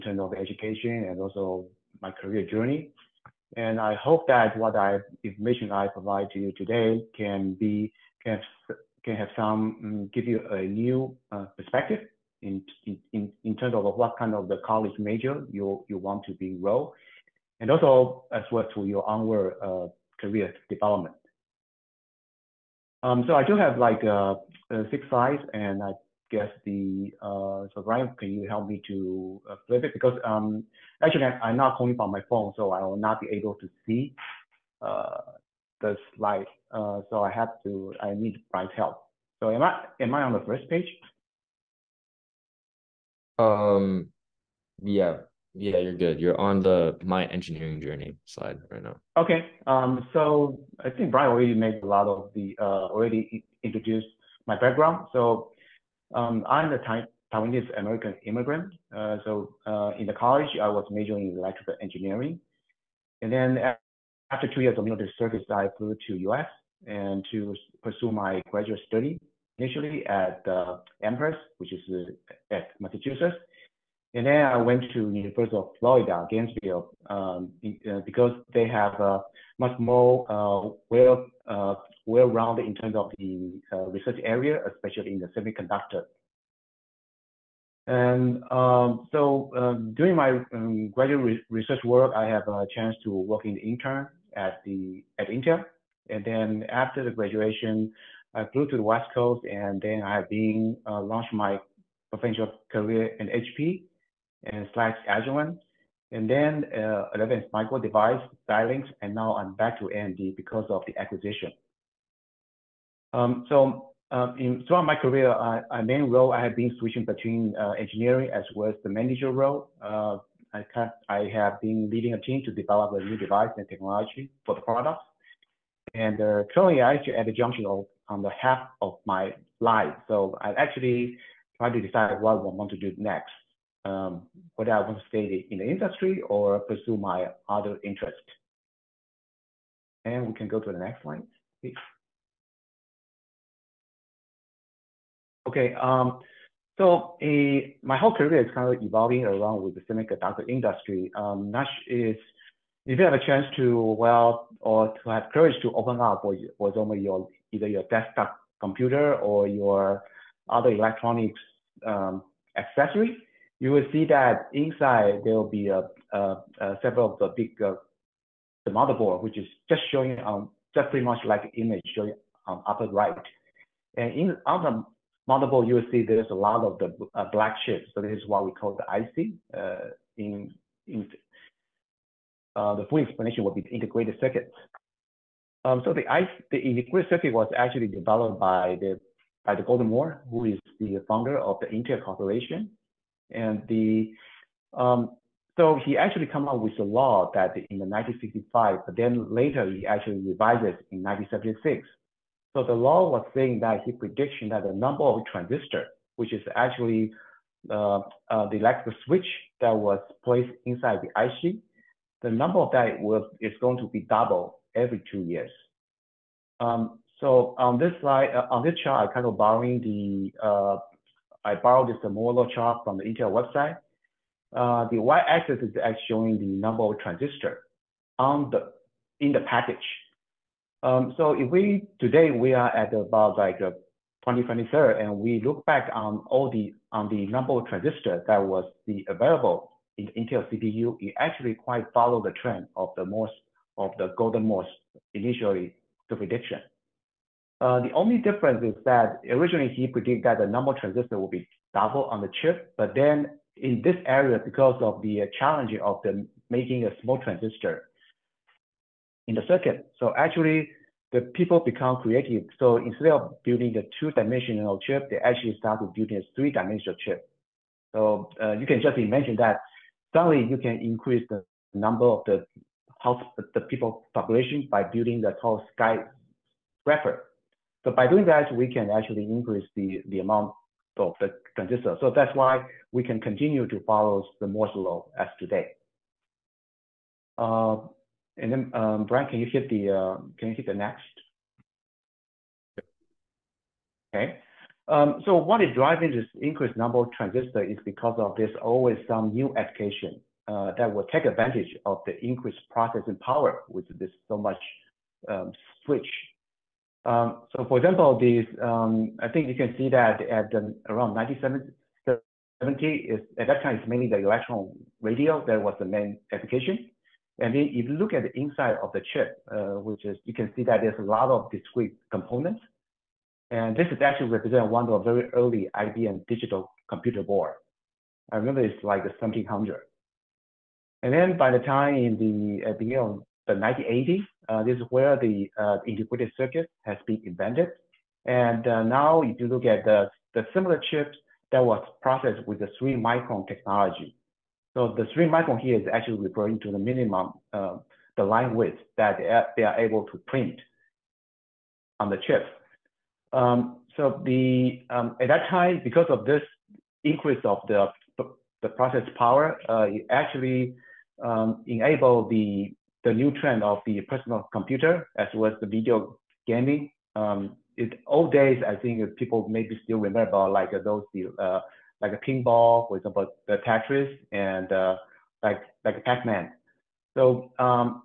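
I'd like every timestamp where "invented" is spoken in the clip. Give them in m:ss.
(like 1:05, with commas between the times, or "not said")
5:37.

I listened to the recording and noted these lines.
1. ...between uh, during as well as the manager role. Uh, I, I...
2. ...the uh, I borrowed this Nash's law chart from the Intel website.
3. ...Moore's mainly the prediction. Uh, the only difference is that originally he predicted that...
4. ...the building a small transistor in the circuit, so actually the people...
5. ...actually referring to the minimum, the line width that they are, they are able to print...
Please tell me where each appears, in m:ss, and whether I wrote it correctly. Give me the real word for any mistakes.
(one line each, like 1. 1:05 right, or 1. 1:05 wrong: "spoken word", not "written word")
1. 1:57 wrong: "engineering", not "during"
2. 3:39 wrong: "Moore", not "Nash"
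3. 4:04 wrong: "initially", not "mainly"
4. 4:16 wrong: "making", not "building"
5. 5:45 right.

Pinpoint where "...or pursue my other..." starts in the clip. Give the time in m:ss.
2:16.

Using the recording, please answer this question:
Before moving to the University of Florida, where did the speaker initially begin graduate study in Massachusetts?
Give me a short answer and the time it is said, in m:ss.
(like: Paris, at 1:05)
Amherst, at 1:11.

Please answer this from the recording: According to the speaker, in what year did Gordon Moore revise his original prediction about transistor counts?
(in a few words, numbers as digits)
1976.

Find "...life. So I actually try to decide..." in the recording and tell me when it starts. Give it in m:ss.
2:09.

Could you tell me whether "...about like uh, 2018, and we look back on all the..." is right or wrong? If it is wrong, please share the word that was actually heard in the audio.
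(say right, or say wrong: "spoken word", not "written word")
wrong: "2023", not "2018".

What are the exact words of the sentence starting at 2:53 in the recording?
And in on the motherboard, you will see there's a lot of the uh, black chips.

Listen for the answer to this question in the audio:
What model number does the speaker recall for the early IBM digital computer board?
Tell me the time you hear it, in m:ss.
5:29.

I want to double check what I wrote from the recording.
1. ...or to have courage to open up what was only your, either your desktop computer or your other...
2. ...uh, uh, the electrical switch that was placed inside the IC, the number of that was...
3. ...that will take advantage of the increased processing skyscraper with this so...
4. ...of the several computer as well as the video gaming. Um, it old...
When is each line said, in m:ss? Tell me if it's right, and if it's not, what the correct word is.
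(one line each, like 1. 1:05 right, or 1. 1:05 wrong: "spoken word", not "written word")
1. 2:34 right
2. 3:27 right
3. 5:00 wrong: "power", not "skyscraper"
4. 6:03 wrong: "personal", not "several".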